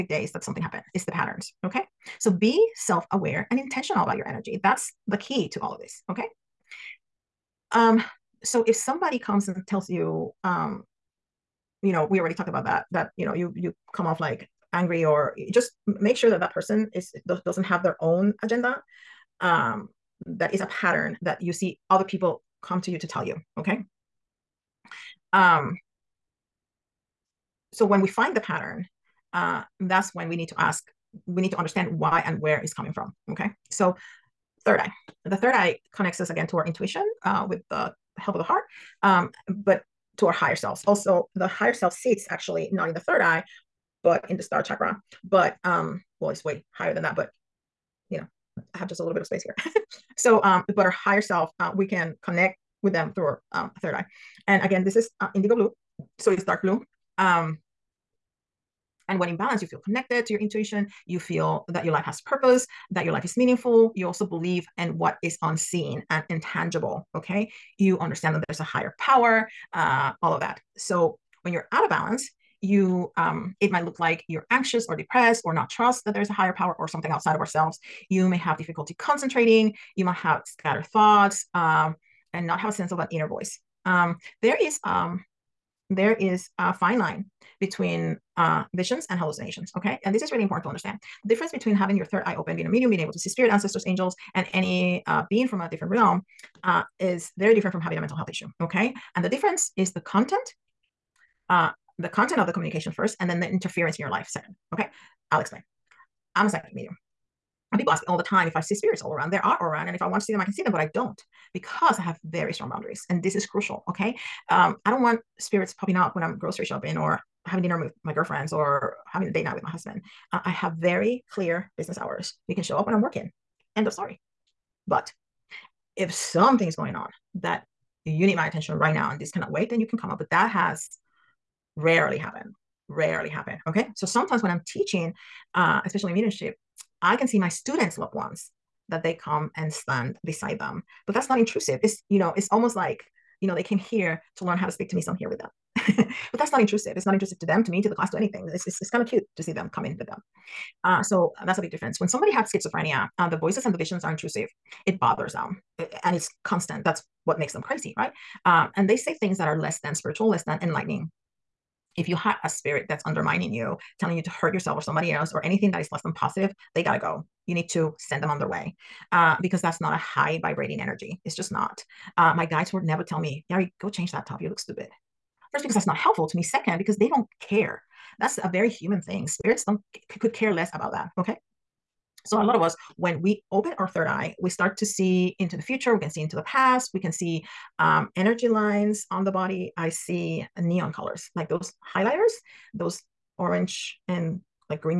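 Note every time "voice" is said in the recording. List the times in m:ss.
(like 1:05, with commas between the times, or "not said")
1:23, 2:33.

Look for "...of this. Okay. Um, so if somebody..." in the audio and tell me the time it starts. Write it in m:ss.
0:05.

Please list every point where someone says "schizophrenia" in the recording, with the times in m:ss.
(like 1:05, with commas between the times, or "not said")
2:32.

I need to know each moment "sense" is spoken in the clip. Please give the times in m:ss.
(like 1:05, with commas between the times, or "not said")
1:22.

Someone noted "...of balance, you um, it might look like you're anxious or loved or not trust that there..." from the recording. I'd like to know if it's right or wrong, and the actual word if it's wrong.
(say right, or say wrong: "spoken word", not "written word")
wrong: "depressed", not "loved".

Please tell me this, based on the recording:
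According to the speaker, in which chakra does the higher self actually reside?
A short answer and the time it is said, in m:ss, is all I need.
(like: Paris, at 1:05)
Star chakra, at 0:44.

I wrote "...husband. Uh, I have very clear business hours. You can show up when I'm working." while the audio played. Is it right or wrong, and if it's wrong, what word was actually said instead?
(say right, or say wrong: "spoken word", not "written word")
right.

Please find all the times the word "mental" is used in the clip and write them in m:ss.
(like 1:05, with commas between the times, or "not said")
1:38.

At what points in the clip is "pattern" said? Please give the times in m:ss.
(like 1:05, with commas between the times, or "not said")
0:01, 0:20, 0:28.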